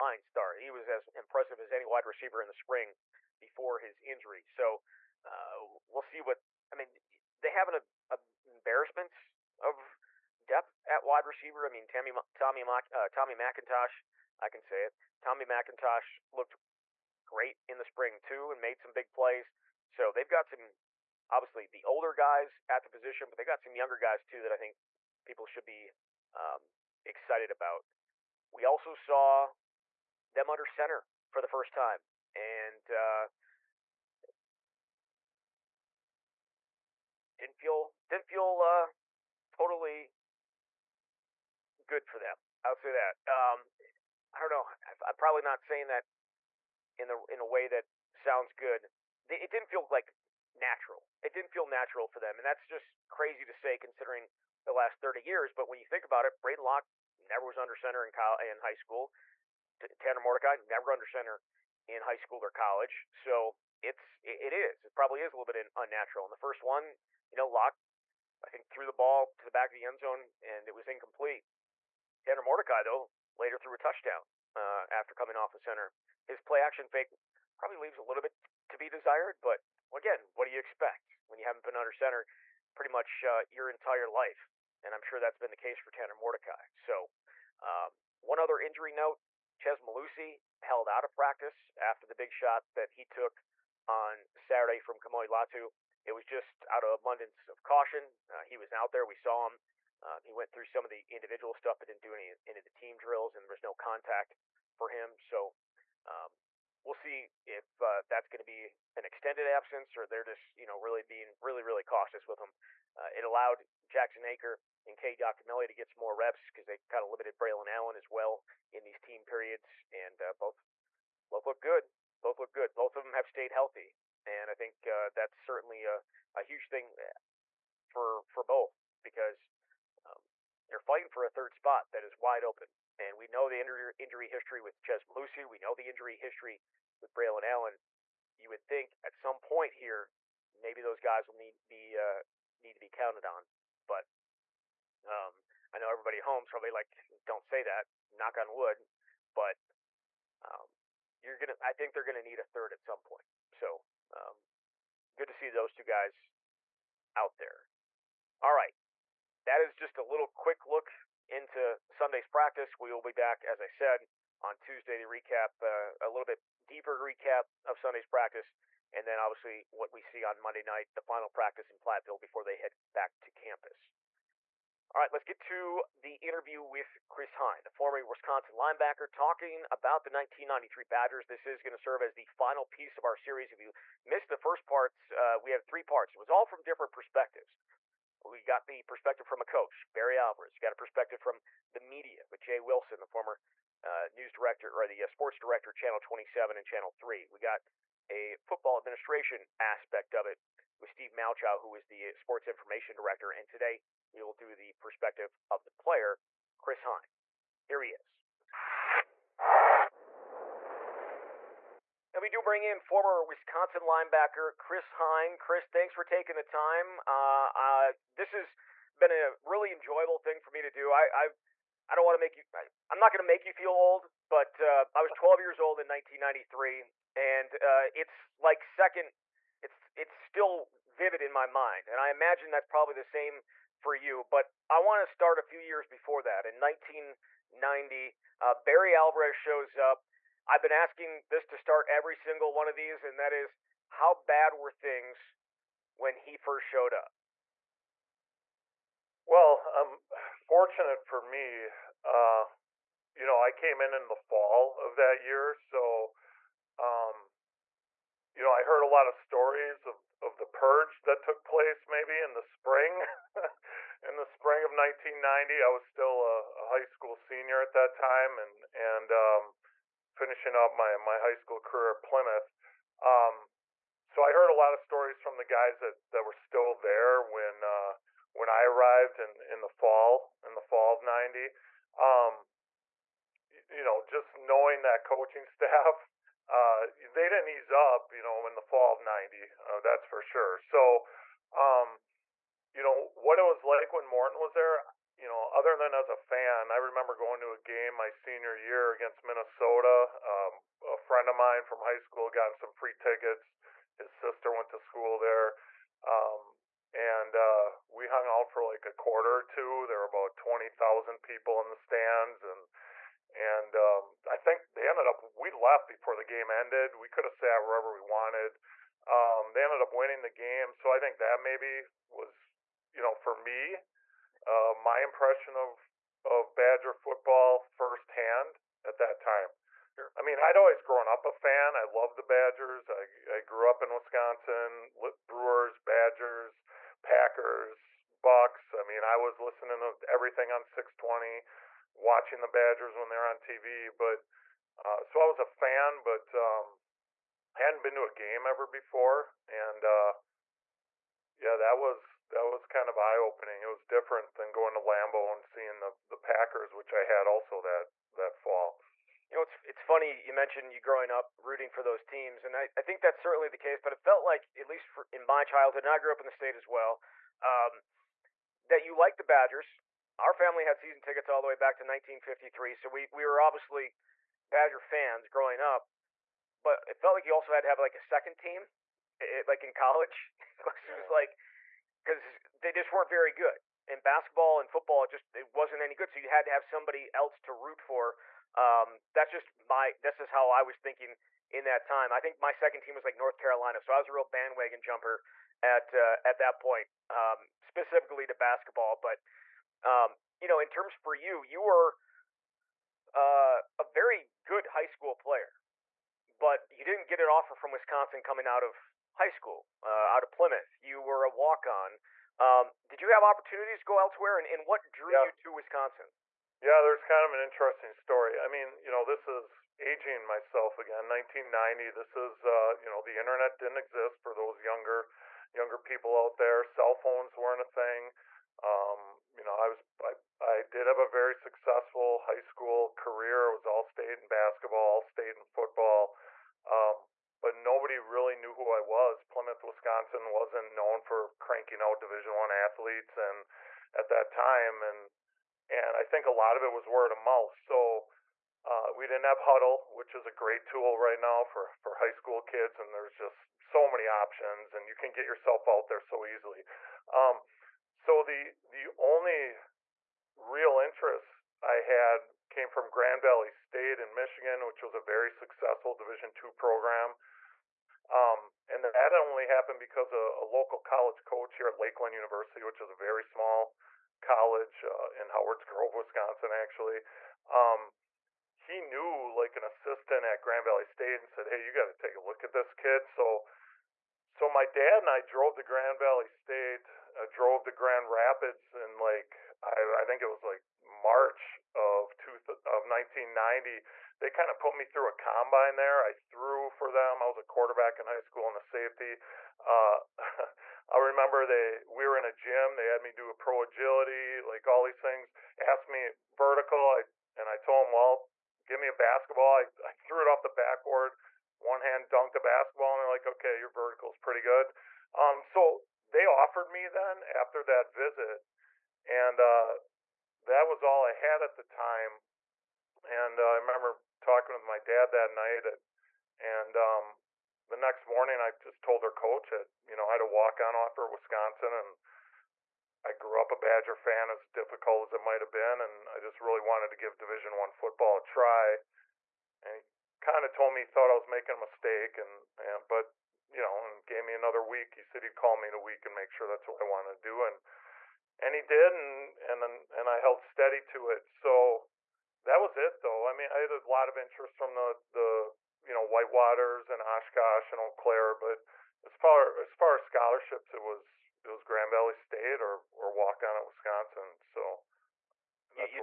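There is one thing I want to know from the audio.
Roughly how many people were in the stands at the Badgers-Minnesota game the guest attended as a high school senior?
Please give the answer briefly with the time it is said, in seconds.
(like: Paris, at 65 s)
20,000, at 310 s.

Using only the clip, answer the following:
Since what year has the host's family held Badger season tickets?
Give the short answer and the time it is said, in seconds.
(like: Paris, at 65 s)
1953, at 371 s.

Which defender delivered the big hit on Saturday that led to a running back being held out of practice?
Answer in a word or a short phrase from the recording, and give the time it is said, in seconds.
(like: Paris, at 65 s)
Kamoi Latu, at 94 s.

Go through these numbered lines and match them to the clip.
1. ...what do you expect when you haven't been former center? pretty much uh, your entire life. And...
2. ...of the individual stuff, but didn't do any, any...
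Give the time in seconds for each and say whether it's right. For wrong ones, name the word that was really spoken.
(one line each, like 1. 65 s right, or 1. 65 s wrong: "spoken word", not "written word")
1. 80 s wrong: "under", not "former"
2. 100 s right.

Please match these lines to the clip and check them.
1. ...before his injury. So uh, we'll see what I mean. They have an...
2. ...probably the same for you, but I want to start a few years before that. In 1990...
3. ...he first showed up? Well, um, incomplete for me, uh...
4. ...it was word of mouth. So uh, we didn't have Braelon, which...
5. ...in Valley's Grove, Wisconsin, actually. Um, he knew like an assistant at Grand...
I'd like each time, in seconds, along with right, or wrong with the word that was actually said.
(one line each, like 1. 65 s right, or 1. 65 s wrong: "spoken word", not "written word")
1. 3 s right
2. 232 s right
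3. 246 s wrong: "fortunate", not "incomplete"
4. 446 s wrong: "Hudl", not "Braelon"
5. 475 s wrong: "Howard", not "Valley".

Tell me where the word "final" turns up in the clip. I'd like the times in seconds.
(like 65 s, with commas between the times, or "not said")
171 s, 182 s.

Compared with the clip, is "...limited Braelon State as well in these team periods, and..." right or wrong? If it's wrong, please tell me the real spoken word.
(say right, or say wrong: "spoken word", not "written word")
wrong: "Allen", not "State".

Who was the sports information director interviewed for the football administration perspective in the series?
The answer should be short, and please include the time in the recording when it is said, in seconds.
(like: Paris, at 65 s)
Steve Malchow, at 200 s.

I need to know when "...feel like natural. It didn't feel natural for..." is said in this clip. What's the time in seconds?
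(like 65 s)
49 s.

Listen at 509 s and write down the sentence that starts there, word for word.
I, I threw it off the backboard one hand dunked a basketball, and they're like, okay, your vertical's pretty good.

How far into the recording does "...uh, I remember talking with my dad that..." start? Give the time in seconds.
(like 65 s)
523 s.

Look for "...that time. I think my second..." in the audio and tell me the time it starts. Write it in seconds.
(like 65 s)
391 s.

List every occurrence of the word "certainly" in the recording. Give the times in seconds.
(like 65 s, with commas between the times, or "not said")
125 s, 363 s.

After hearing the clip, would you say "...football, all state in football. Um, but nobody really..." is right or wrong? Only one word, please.
wrong.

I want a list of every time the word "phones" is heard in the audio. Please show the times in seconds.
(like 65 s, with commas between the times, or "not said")
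426 s.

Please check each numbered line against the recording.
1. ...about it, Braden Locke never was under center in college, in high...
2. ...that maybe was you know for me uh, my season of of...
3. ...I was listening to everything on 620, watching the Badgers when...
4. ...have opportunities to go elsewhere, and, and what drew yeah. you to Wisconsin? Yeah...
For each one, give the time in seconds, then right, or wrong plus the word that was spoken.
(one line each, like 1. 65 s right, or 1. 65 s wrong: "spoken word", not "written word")
1. 56 s right
2. 321 s wrong: "impression", not "season"
3. 339 s right
4. 413 s right.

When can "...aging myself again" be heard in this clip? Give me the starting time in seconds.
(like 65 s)
419 s.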